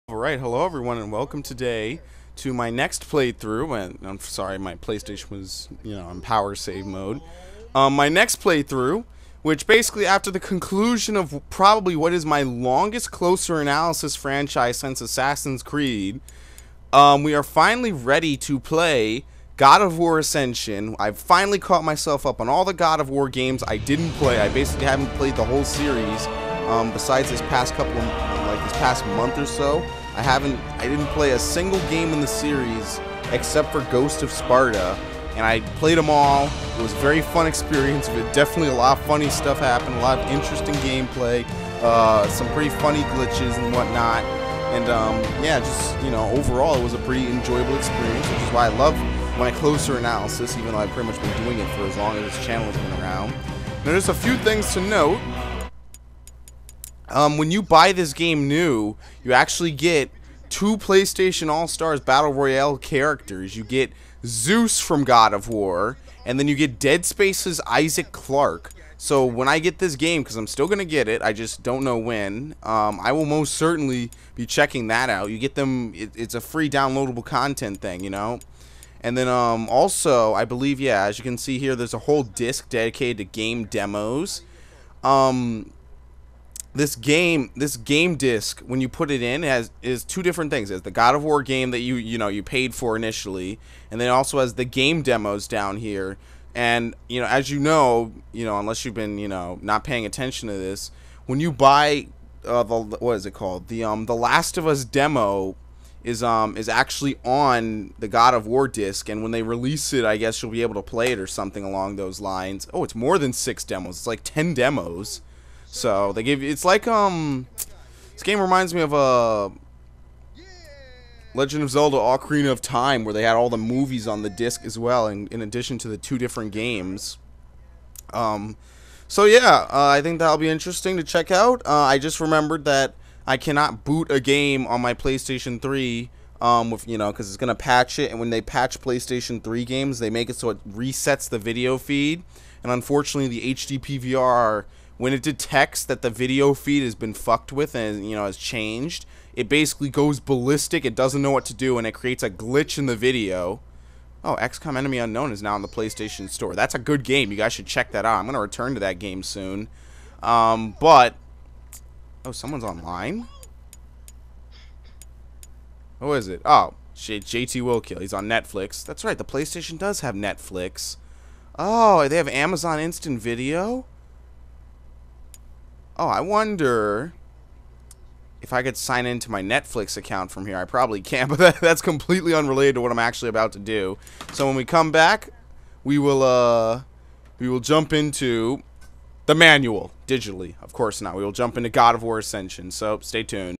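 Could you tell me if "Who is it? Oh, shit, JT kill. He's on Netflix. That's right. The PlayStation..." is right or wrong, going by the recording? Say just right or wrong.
right.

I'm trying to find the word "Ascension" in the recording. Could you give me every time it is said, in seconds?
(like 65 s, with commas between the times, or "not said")
20 s, 192 s.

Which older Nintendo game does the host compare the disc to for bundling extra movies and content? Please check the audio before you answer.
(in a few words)
Legend of Zelda Ocarina of Time.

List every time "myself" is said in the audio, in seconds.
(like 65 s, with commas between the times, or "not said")
21 s.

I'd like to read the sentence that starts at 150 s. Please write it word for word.
It doesn't know what to do, and it creates a glitch in the video.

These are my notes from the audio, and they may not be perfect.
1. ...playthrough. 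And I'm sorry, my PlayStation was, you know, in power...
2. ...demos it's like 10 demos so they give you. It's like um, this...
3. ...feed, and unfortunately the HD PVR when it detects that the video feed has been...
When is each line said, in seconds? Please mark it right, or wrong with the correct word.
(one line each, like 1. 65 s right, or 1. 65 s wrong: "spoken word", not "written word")
1. 3 s right
2. 113 s right
3. 141 s right.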